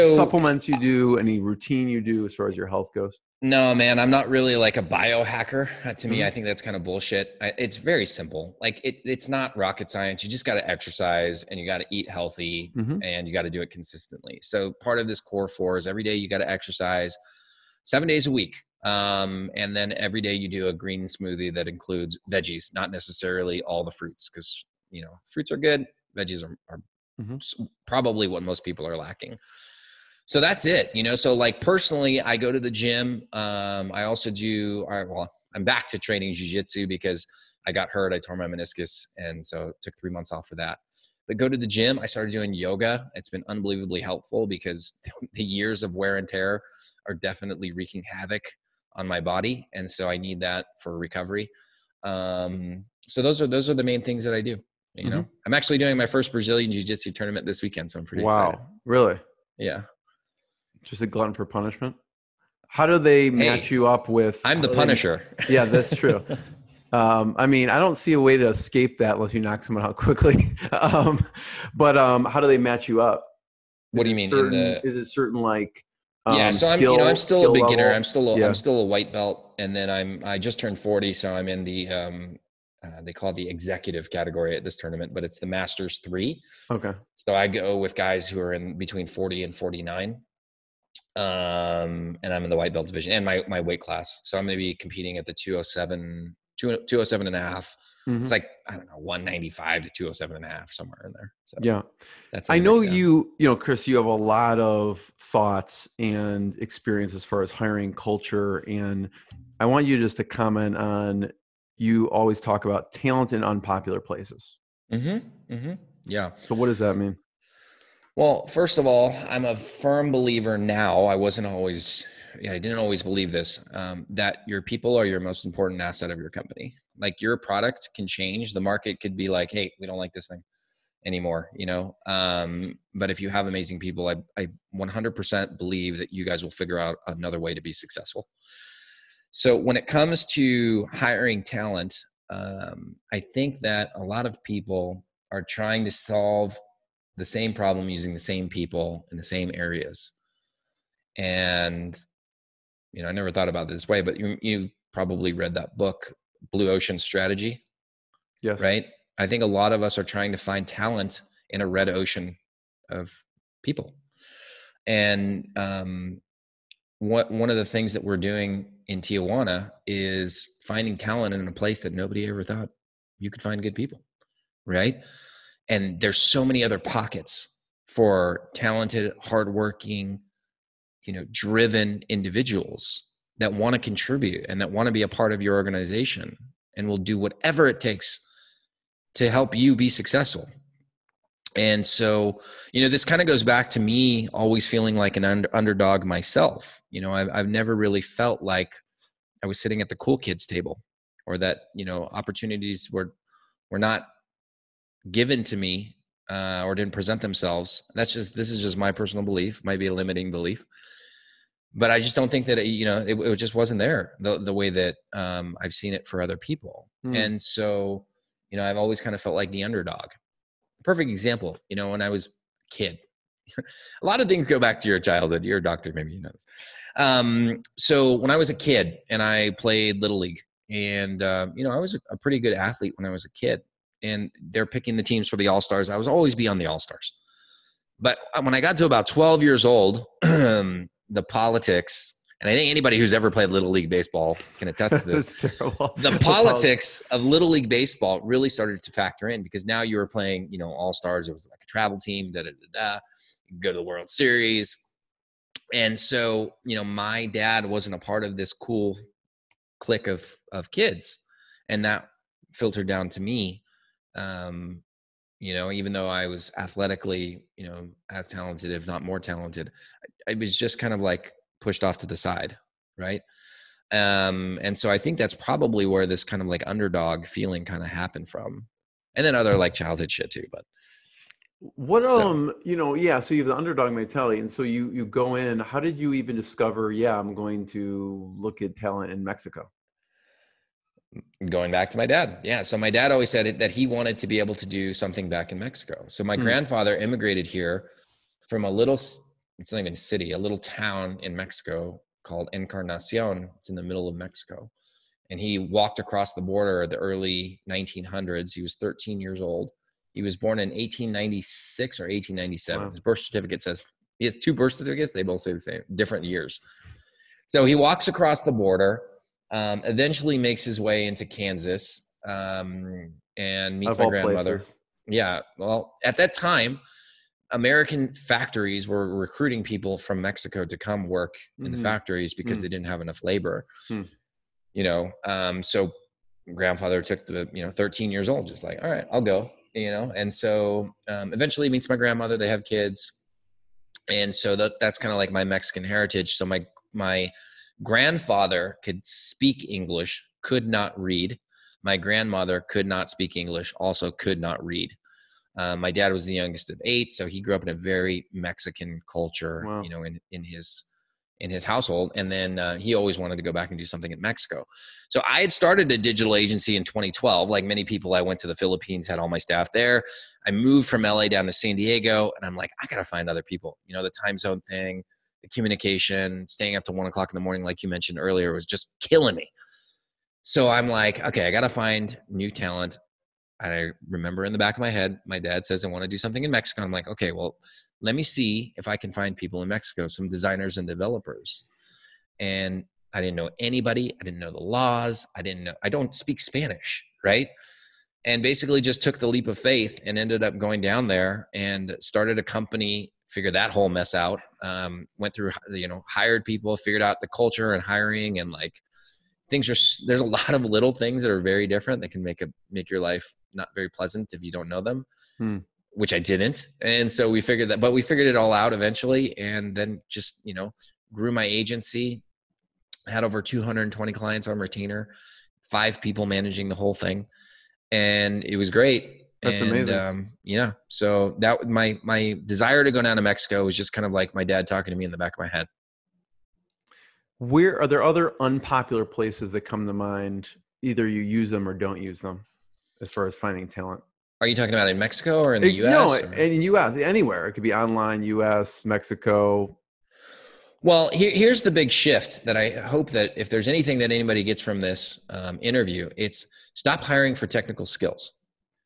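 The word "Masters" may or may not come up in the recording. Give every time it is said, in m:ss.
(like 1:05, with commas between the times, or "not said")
1:25.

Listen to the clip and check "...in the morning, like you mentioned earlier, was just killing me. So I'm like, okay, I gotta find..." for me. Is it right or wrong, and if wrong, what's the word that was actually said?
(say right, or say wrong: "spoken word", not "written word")
right.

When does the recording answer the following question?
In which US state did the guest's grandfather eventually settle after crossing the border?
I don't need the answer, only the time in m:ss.
5:21.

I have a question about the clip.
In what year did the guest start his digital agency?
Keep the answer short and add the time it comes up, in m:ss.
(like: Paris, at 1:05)
2012, at 6:06.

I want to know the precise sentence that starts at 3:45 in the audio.
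You're a doctor, maybe you know this.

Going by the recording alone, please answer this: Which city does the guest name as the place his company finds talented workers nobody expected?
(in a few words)
Tijuana.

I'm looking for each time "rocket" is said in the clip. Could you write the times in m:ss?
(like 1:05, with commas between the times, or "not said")
0:09.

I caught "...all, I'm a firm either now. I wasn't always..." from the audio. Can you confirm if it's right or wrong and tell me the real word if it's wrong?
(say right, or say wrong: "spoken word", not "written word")
wrong: "believer", not "either".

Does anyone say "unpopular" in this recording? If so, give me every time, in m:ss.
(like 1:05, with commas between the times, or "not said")
1:53, 7:18.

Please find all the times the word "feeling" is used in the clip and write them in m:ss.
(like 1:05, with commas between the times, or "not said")
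3:14, 4:37.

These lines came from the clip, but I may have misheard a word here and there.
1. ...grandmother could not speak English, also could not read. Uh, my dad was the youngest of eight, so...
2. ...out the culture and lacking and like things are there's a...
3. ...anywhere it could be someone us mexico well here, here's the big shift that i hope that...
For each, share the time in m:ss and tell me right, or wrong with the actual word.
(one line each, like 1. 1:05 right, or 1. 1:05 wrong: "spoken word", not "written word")
1. 5:51 right
2. 6:47 wrong: "hiring", not "lacking"
3. 7:26 wrong: "online", not "someone".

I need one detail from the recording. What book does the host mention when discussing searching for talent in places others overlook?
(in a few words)
Blue Ocean Strategy.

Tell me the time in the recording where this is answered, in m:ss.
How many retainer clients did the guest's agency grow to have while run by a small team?
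7:03.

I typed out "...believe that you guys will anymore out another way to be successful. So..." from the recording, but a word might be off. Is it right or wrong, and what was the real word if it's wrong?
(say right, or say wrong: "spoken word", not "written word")
wrong: "figure", not "anymore".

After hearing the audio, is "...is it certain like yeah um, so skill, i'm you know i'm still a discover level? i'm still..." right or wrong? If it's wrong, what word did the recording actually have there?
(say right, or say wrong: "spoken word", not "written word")
wrong: "beginner", not "discover".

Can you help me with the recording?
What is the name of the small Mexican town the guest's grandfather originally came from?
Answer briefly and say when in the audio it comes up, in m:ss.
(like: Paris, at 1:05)
Encarnacion, at 5:02.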